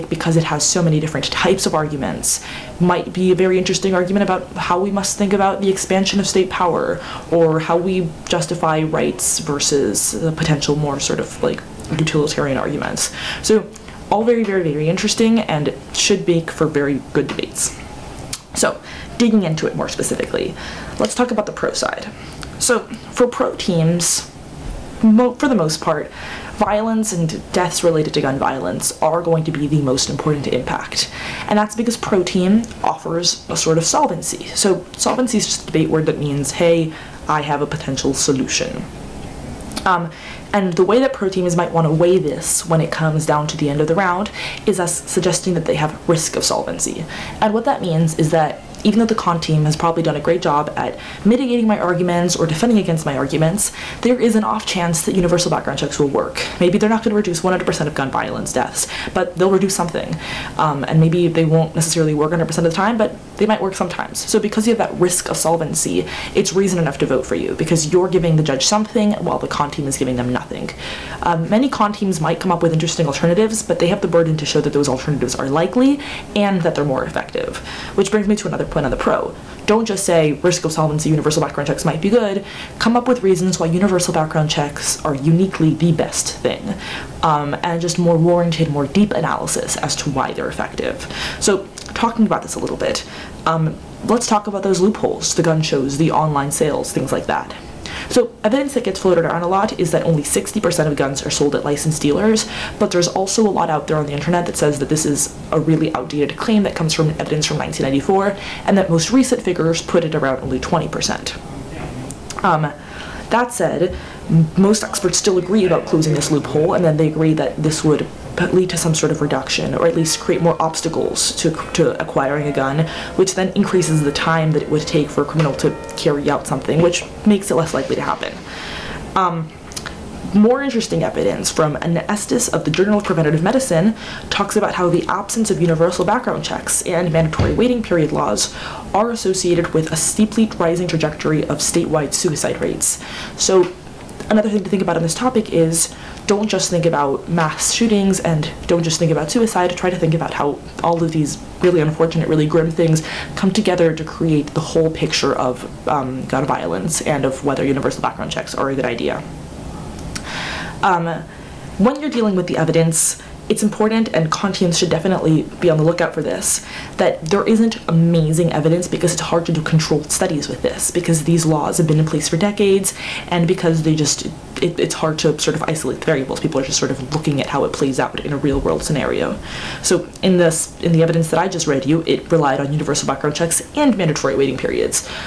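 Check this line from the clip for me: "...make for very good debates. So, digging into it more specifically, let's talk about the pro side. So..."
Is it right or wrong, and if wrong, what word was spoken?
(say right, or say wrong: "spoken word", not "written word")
right.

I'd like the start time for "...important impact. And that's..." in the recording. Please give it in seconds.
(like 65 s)
30 s.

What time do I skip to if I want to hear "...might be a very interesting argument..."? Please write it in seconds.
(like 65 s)
2 s.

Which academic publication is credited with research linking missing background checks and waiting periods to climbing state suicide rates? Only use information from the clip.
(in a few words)
Journal of Preventative Medicine.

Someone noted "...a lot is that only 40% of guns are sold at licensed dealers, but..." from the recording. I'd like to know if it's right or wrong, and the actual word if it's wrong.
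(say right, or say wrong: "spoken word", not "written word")
wrong: "60", not "40".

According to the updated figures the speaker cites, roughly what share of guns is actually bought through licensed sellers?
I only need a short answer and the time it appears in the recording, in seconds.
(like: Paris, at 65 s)
20%, at 110 s.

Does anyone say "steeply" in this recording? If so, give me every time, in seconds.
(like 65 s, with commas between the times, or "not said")
139 s.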